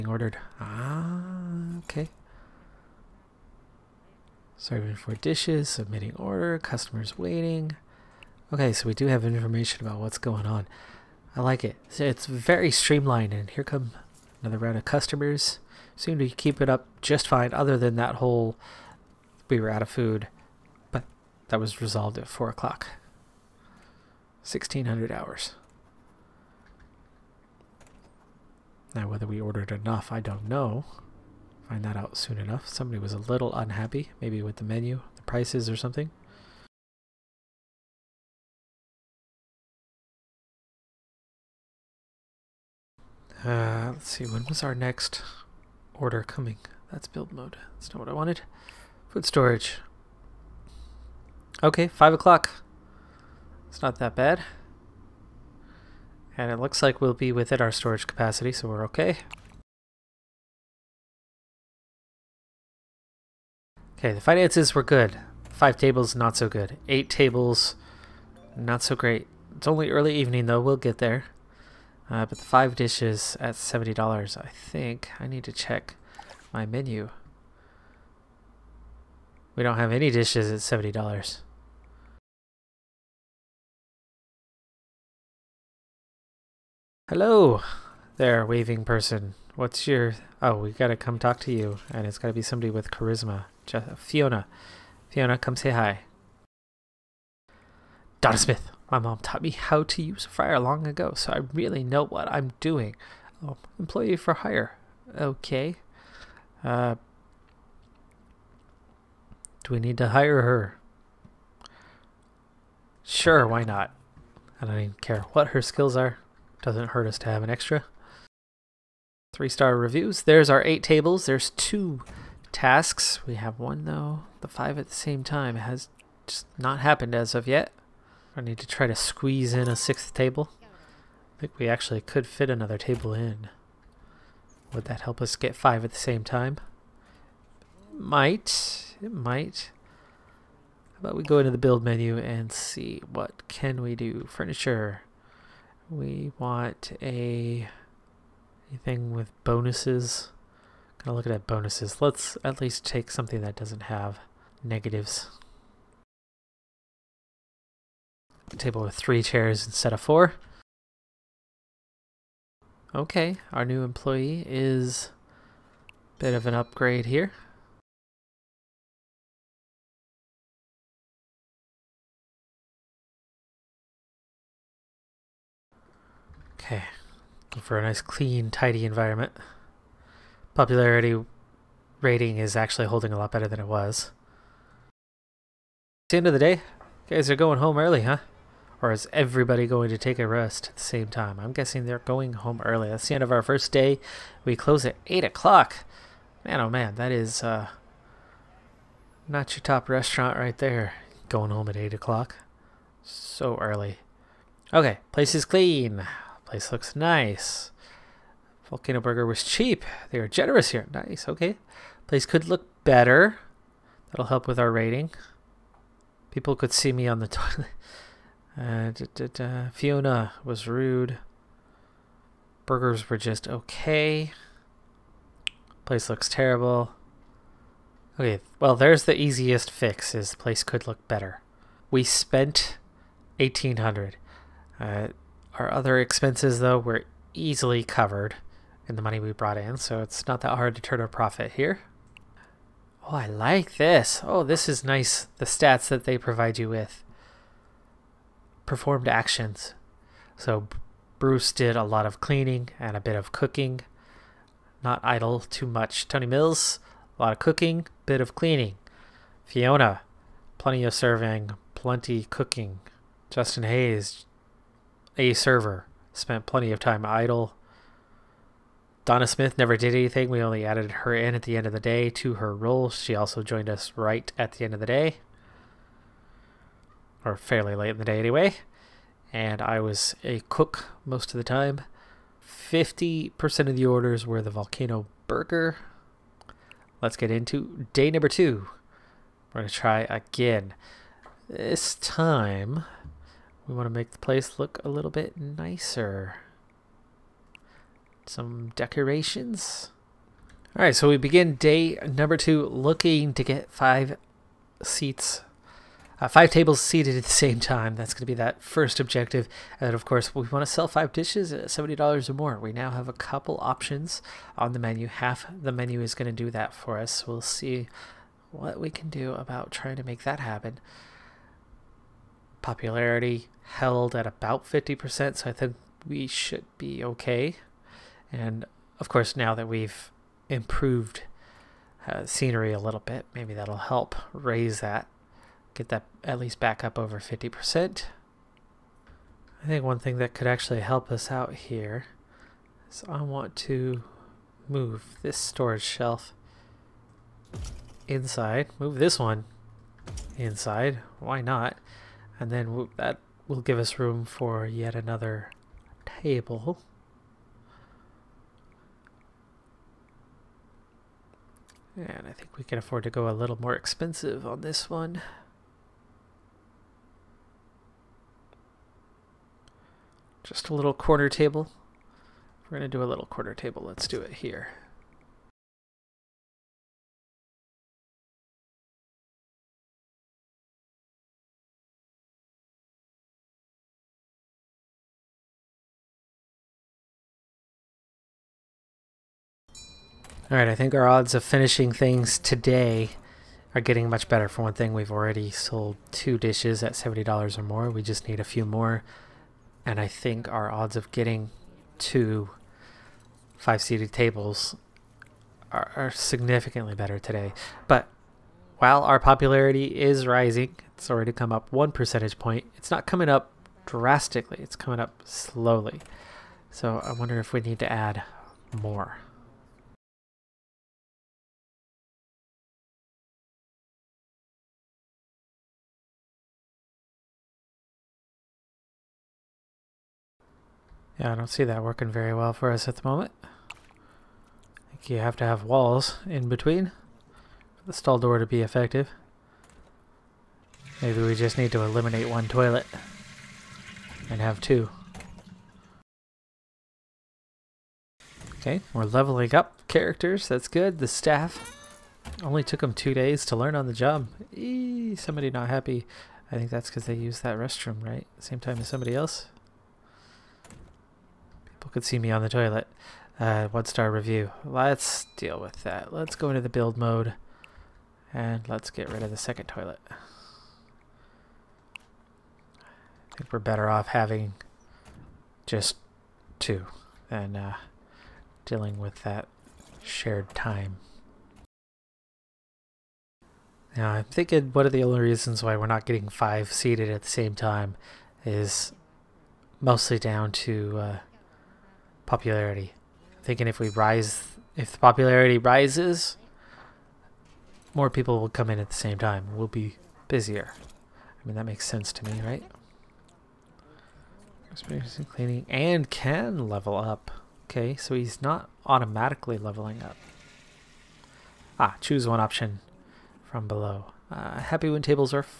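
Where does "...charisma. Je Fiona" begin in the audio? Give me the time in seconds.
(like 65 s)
92 s.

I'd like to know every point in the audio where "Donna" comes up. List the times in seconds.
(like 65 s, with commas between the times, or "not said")
98 s, 269 s.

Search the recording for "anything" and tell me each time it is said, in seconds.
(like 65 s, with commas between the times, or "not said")
148 s, 269 s.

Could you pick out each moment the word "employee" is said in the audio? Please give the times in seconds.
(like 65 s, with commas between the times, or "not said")
103 s, 163 s.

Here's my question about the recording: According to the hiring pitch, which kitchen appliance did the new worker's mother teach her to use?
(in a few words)
fryer.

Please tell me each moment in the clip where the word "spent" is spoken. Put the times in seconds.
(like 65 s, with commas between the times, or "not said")
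232 s, 266 s.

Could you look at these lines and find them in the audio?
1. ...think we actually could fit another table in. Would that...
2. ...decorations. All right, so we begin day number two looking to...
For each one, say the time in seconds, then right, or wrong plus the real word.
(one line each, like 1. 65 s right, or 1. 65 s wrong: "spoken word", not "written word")
1. 131 s right
2. 298 s right.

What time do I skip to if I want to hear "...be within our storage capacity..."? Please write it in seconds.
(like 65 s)
57 s.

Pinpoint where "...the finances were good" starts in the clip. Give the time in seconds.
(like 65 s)
64 s.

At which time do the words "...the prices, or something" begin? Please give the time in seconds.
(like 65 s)
35 s.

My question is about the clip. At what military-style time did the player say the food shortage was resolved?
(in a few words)
1600 hours.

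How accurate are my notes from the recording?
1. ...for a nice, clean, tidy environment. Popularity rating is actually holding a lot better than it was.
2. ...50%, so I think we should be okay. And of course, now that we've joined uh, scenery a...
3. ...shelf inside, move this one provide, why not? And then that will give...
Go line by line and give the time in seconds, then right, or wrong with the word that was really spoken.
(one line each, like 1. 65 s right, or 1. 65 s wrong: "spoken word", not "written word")
1. 177 s right
2. 324 s wrong: "improved", not "joined"
3. 345 s wrong: "inside", not "provide".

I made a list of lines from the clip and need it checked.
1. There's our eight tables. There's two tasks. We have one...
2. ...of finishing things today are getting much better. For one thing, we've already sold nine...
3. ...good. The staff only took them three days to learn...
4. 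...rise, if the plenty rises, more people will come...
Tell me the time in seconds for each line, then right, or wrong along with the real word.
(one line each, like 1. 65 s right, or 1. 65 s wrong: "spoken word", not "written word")
1. 120 s right
2. 391 s wrong: "two", not "nine"
3. 450 s wrong: "two", not "three"
4. 493 s wrong: "popularity", not "plenty".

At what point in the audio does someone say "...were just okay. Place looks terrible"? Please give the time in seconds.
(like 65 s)
223 s.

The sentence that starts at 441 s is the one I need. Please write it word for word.
Maybe we just need to eliminate one toilet and have two.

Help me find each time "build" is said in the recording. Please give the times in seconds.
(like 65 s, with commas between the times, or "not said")
47 s, 141 s, 466 s.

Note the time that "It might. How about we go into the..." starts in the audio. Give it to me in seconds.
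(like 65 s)
139 s.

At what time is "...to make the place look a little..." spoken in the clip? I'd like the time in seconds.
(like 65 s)
293 s.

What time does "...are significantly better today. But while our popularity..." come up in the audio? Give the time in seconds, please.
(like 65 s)
405 s.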